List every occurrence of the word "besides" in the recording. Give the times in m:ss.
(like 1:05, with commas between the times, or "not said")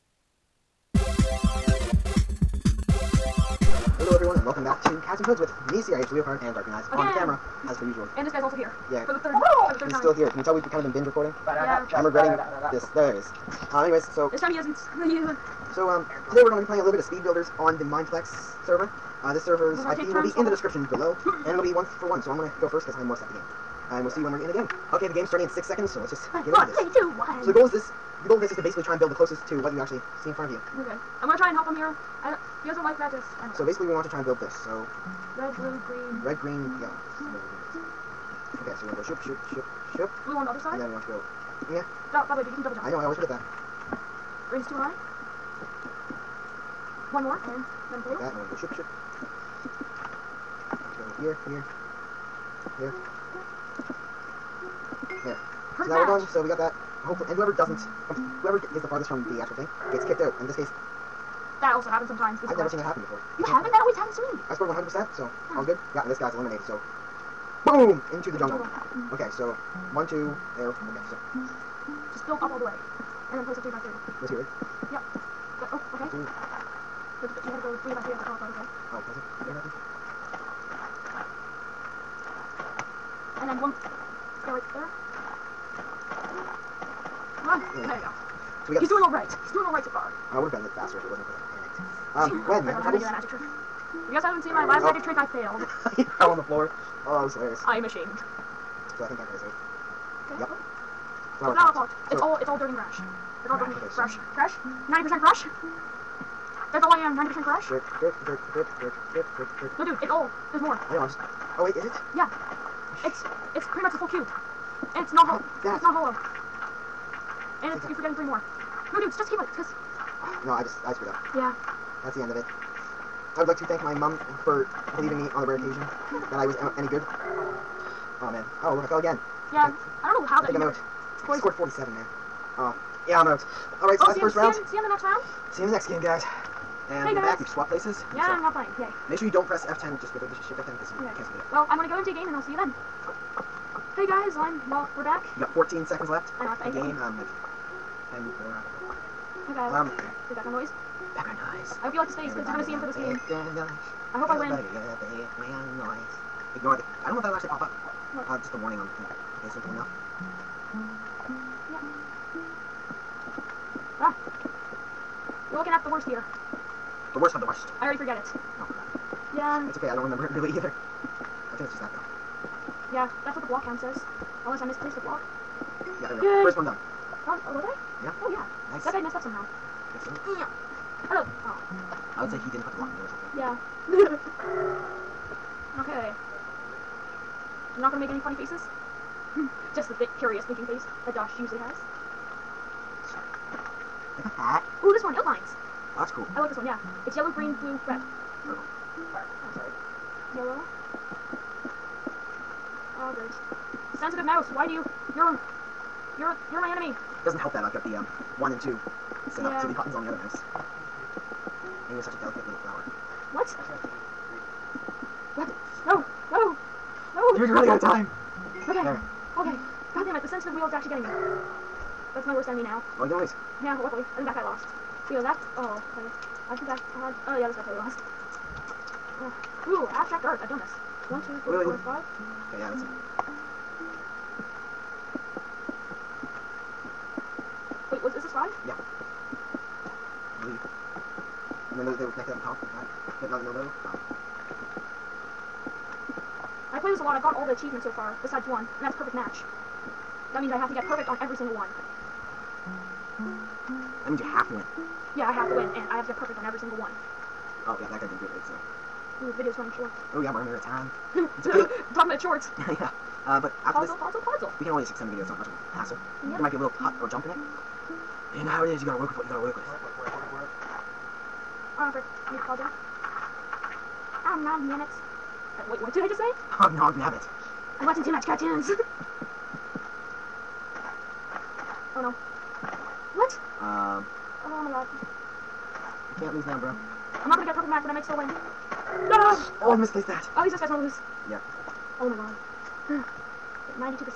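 4:08.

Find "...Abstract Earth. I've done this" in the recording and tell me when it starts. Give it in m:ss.
3:49.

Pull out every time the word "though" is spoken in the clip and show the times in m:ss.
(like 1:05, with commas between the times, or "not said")
2:51, 4:03.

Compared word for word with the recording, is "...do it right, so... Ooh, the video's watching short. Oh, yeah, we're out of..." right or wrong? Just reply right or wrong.
wrong.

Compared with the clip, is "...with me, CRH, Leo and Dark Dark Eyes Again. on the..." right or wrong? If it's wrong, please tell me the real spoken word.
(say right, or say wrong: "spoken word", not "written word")
wrong: "Green", not "Dark".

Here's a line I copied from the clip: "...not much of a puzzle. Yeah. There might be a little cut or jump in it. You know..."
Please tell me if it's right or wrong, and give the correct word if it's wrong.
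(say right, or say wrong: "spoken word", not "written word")
wrong: "hassle", not "puzzle".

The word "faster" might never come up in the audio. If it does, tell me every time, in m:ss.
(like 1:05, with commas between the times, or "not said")
1:30.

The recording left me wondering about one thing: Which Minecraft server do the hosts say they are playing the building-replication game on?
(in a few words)
Mineplex.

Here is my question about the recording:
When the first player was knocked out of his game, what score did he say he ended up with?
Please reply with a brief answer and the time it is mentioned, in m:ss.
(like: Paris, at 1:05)
47, at 2:11.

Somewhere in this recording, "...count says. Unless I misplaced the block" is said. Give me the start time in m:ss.
2:53.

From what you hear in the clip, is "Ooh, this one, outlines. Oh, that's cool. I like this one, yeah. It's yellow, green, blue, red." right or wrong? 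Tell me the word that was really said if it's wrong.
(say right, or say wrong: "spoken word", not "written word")
right.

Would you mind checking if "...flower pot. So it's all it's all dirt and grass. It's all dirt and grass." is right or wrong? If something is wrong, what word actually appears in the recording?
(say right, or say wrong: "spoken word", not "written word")
right.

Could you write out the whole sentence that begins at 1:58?
No, dude, just keep it, because...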